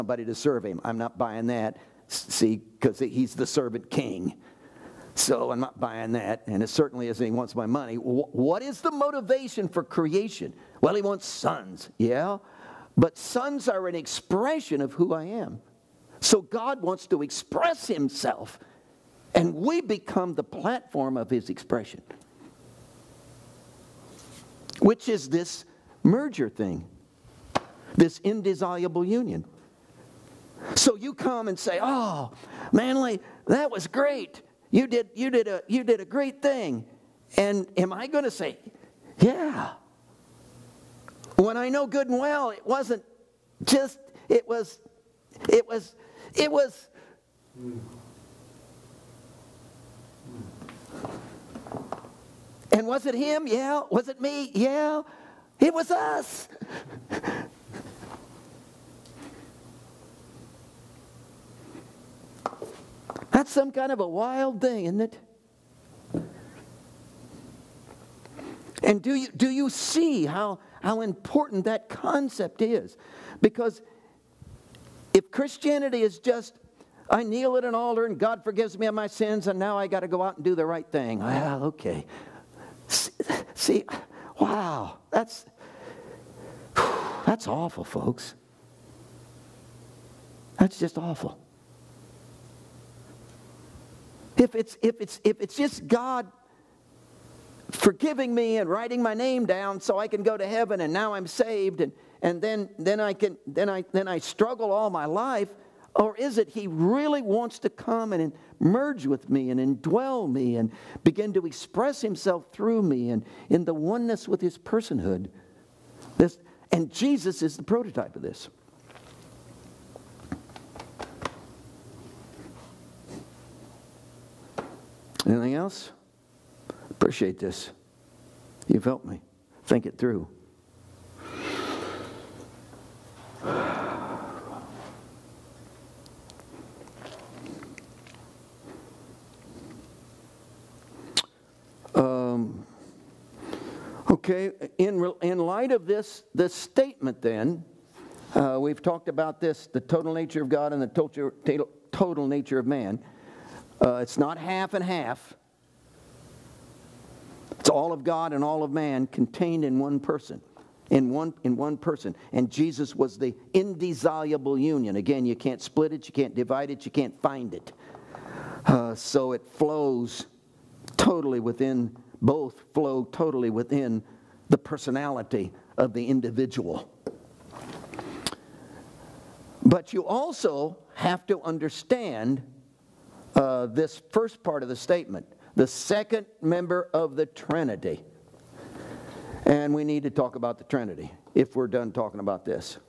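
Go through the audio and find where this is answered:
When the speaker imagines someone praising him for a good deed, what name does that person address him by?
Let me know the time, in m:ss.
0:32.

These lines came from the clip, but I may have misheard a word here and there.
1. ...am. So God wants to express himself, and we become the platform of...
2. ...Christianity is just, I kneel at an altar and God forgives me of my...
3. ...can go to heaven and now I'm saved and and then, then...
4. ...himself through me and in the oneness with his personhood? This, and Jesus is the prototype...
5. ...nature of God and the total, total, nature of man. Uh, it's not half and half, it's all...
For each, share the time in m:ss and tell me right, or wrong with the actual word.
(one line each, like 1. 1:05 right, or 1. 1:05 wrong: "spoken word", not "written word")
1. 0:15 right
2. 1:15 right
3. 1:40 right
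4. 1:51 right
5. 2:30 right.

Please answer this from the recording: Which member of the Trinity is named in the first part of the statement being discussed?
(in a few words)
second member.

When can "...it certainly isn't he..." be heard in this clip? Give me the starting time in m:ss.
0:06.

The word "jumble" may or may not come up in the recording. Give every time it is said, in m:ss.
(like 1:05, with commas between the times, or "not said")
not said.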